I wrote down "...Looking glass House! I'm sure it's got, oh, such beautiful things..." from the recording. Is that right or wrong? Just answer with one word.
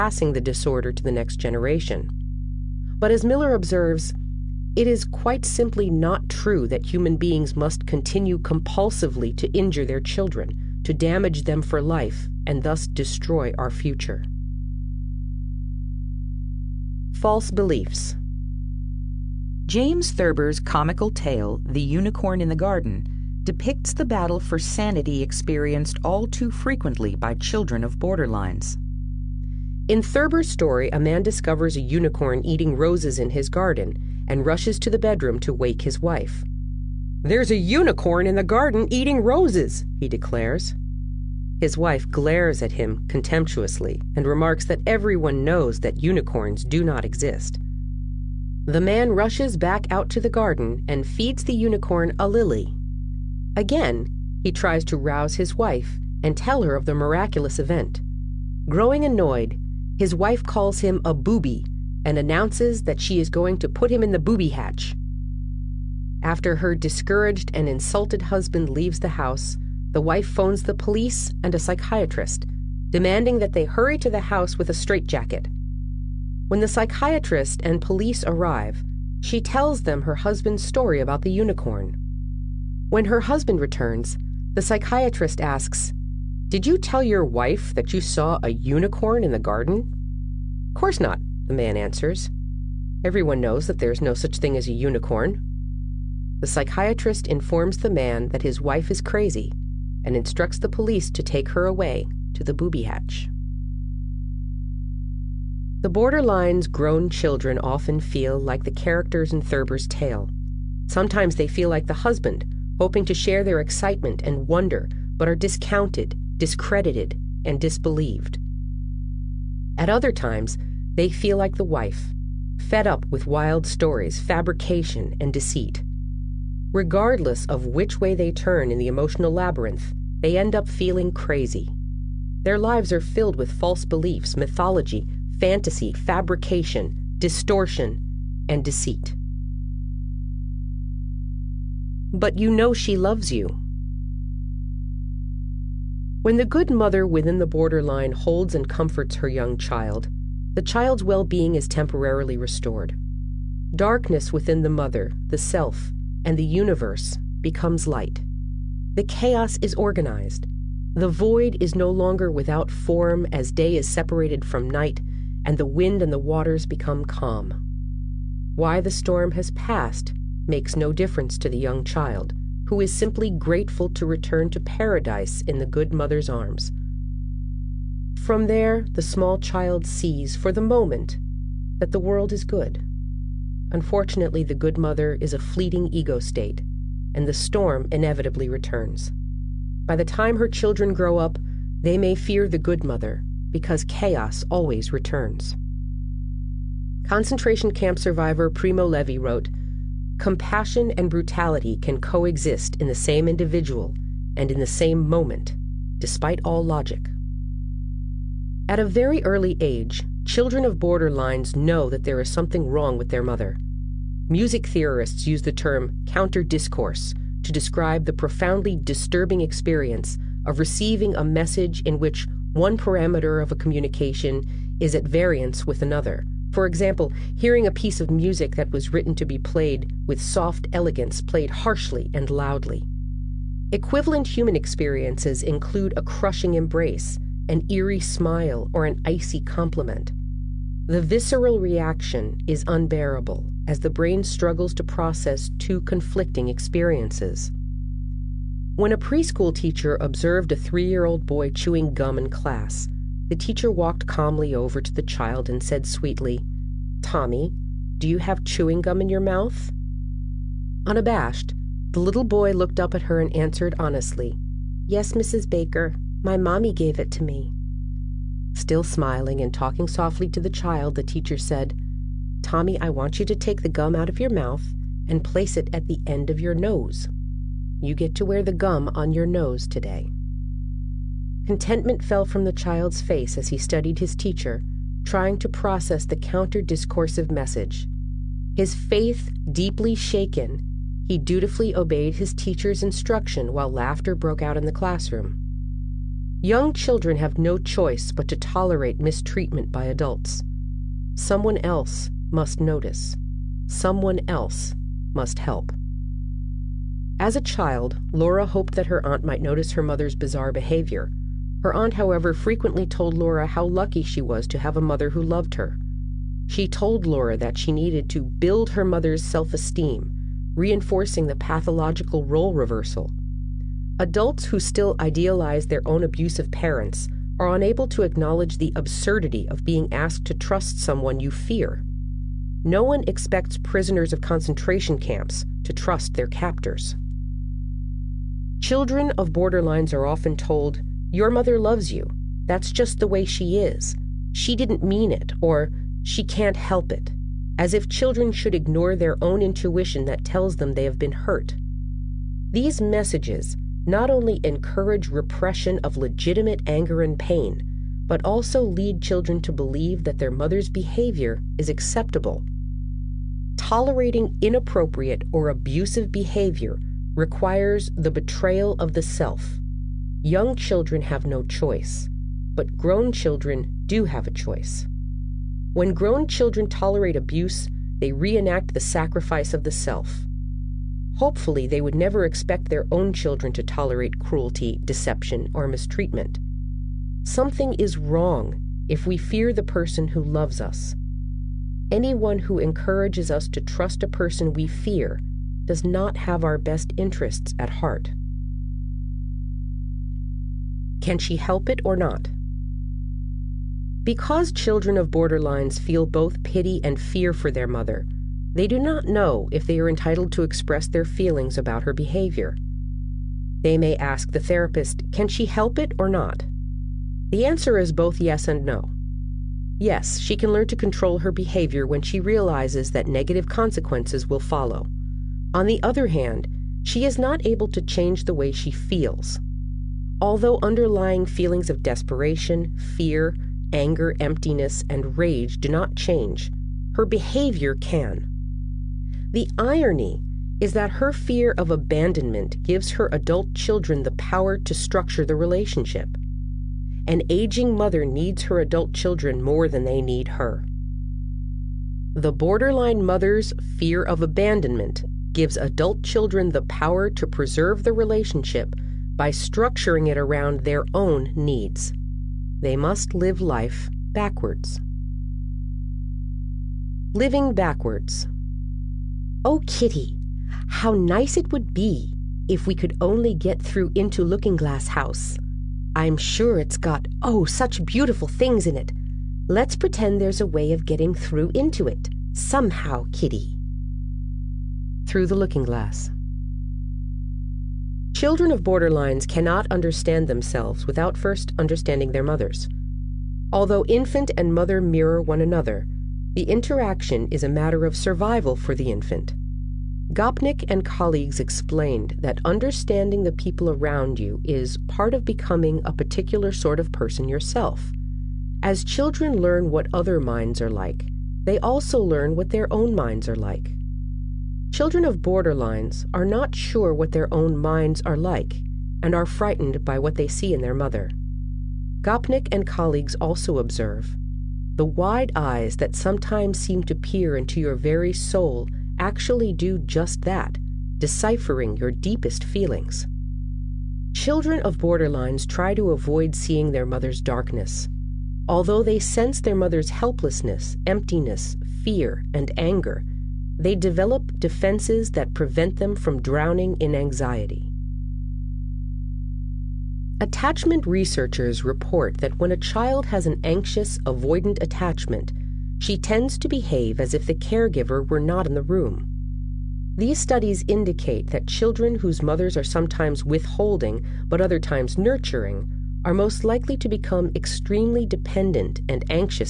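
right.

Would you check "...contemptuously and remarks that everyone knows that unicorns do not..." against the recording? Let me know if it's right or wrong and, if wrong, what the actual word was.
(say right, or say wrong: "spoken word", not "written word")
right.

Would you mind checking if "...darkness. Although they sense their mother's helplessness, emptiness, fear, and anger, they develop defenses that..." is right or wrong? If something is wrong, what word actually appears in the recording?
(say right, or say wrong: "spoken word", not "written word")
right.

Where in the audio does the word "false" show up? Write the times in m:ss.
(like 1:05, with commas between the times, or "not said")
0:17, 2:13.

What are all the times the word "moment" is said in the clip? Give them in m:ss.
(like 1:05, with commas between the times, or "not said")
3:00, 3:25.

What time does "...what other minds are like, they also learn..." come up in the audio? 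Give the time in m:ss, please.
8:29.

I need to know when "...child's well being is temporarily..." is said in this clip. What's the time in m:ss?
2:30.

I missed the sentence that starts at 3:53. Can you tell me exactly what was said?
Equivalent human experiences include a crushing embrace, an eerie smile, or an icy compliment.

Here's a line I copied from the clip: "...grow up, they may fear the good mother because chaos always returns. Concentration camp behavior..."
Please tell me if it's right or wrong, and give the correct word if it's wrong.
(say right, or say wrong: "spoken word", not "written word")
wrong: "survivor", not "behavior".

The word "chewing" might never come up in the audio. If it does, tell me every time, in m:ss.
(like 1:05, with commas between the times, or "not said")
4:11, 4:18.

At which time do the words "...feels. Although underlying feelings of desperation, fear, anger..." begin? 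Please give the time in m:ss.
7:08.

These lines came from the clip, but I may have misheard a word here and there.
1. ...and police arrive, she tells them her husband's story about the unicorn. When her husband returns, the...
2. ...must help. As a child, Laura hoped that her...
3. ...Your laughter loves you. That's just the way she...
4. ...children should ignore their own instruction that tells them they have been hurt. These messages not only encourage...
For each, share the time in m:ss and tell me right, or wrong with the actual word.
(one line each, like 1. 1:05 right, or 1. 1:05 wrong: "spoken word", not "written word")
1. 1:17 right
2. 5:05 right
3. 5:41 wrong: "mother", not "laughter"
4. 5:47 wrong: "intuition", not "instruction".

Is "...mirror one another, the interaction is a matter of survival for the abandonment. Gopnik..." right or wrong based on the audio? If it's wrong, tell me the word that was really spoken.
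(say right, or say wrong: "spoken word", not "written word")
wrong: "infant", not "abandonment".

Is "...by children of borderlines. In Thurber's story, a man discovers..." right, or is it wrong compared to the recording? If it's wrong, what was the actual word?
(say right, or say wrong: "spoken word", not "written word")
right.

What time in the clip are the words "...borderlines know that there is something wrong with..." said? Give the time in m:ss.
3:30.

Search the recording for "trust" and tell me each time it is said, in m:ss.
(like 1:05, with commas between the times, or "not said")
5:30, 5:35, 6:33.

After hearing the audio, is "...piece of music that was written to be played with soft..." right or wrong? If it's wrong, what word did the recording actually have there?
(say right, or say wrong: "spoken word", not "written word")
right.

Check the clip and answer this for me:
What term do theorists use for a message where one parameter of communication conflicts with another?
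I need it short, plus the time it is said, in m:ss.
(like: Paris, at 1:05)
Counter discourse, at 3:36.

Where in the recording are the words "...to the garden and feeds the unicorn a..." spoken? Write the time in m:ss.
0:50.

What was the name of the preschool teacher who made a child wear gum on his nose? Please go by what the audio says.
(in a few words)
Mrs. Baker.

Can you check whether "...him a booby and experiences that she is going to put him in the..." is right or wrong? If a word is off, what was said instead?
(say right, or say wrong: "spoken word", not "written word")
wrong: "announces", not "experiences".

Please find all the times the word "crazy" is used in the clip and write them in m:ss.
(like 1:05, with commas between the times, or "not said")
1:39, 2:11.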